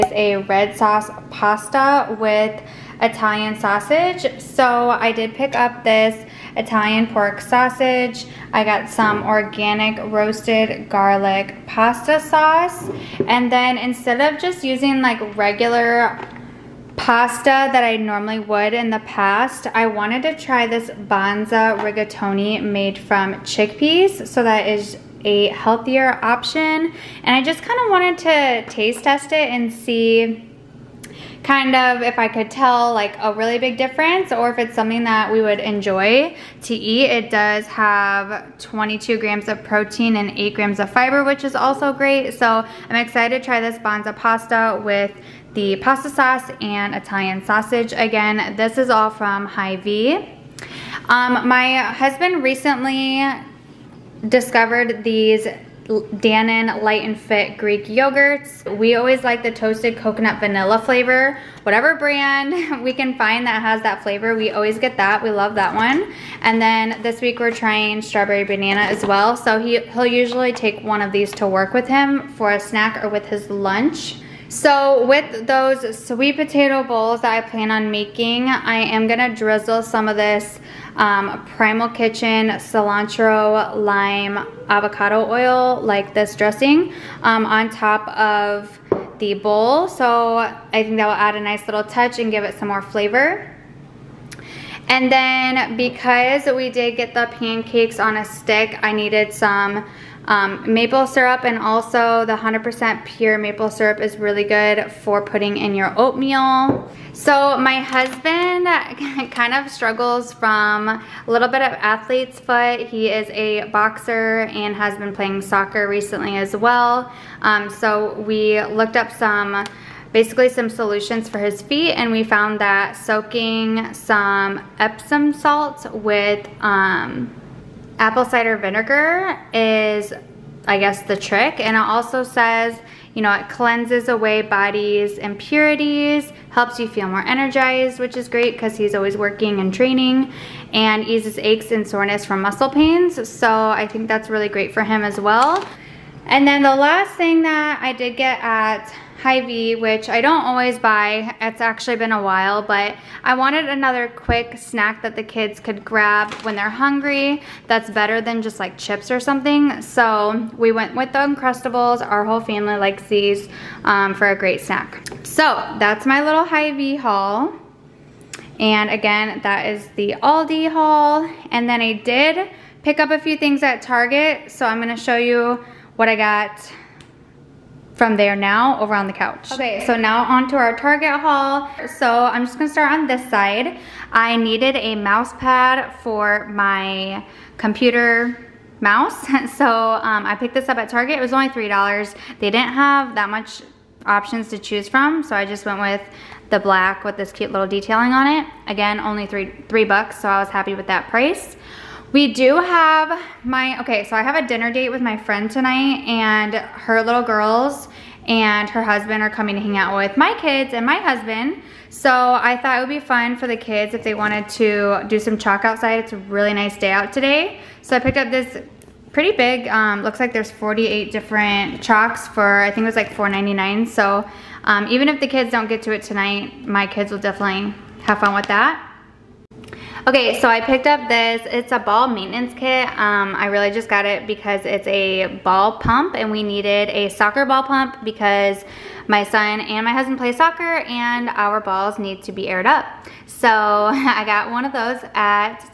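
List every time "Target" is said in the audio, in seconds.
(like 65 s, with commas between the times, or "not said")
173 s, 180 s, 190 s.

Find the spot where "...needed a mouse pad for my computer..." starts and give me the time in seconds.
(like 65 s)
184 s.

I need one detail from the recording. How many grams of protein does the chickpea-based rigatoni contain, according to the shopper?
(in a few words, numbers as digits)
22 grams.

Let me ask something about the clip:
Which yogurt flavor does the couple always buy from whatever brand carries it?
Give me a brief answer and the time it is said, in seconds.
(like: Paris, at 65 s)
toasted coconut vanilla, at 59 s.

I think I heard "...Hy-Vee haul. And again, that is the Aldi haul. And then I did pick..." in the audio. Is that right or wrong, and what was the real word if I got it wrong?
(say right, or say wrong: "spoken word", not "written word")
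right.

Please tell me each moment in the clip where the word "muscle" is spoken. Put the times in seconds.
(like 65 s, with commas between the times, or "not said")
142 s.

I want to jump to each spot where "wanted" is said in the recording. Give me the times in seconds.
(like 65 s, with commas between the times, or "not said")
19 s, 27 s, 153 s, 214 s.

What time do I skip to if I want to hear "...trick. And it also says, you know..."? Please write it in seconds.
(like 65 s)
131 s.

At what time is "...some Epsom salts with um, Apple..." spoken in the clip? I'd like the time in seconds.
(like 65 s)
123 s.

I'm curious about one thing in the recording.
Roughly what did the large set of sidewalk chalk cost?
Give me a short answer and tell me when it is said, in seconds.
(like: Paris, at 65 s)
$4.99, at 223 s.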